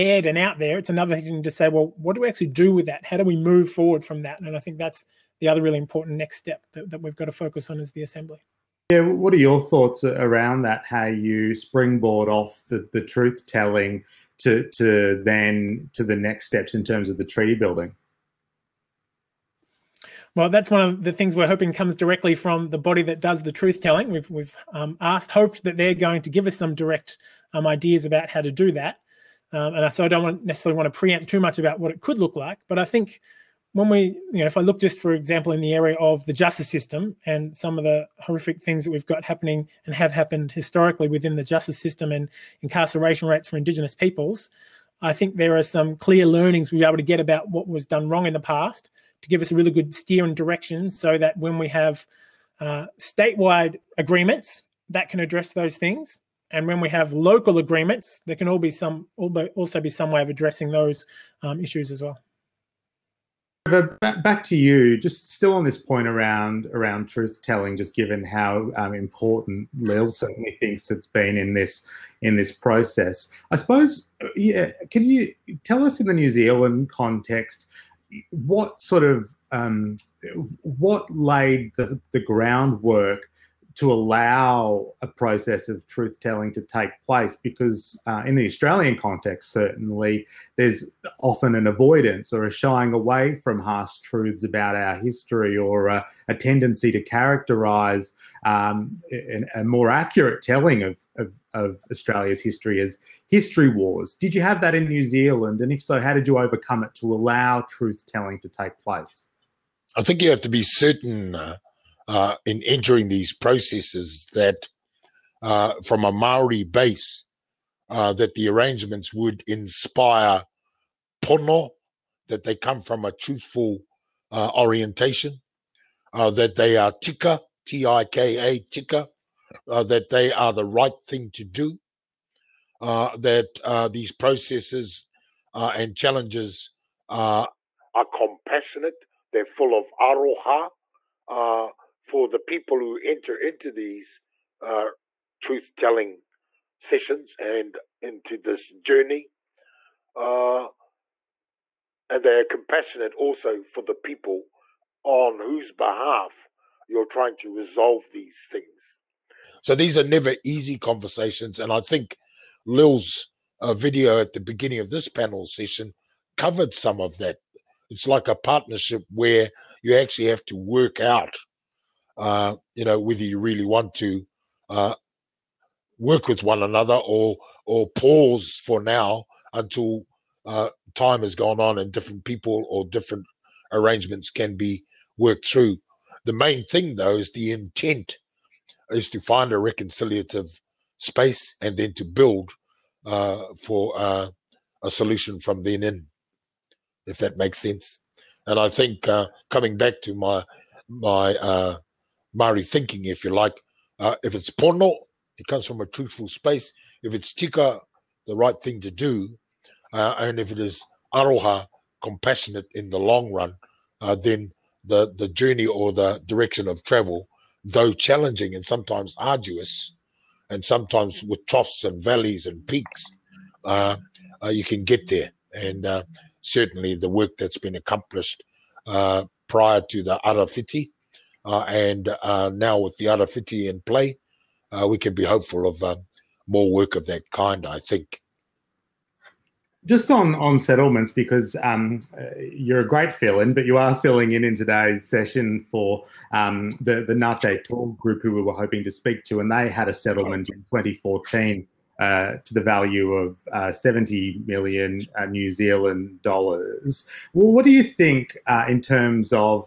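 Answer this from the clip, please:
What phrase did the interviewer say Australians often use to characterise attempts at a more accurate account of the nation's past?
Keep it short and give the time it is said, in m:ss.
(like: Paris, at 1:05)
history wars, at 1:43.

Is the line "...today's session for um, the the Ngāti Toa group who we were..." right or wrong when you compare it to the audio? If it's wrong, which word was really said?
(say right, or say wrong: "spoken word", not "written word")
right.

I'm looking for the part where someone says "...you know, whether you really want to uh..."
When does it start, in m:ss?
2:52.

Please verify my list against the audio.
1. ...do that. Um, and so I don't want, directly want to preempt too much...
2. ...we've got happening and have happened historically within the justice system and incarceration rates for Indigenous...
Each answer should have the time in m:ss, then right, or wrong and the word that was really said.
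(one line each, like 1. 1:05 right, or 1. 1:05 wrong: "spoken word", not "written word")
1. 0:28 wrong: "necessarily", not "directly"
2. 0:38 right.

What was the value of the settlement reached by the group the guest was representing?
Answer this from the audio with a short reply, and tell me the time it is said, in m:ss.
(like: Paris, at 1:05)
70 million New Zealand dollars, at 4:13.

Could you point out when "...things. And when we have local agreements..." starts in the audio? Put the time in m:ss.
0:55.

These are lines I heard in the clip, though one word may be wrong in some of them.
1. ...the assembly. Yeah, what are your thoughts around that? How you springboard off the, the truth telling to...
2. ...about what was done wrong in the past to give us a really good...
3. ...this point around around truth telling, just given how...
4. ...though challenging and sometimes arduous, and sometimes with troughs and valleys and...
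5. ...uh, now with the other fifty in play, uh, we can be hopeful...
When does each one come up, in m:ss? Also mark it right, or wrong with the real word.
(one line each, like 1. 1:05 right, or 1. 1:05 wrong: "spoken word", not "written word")
1. 0:07 right
2. 0:47 right
3. 1:05 right
4. 3:37 right
5. 3:52 right.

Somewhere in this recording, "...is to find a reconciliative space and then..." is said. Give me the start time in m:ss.
3:08.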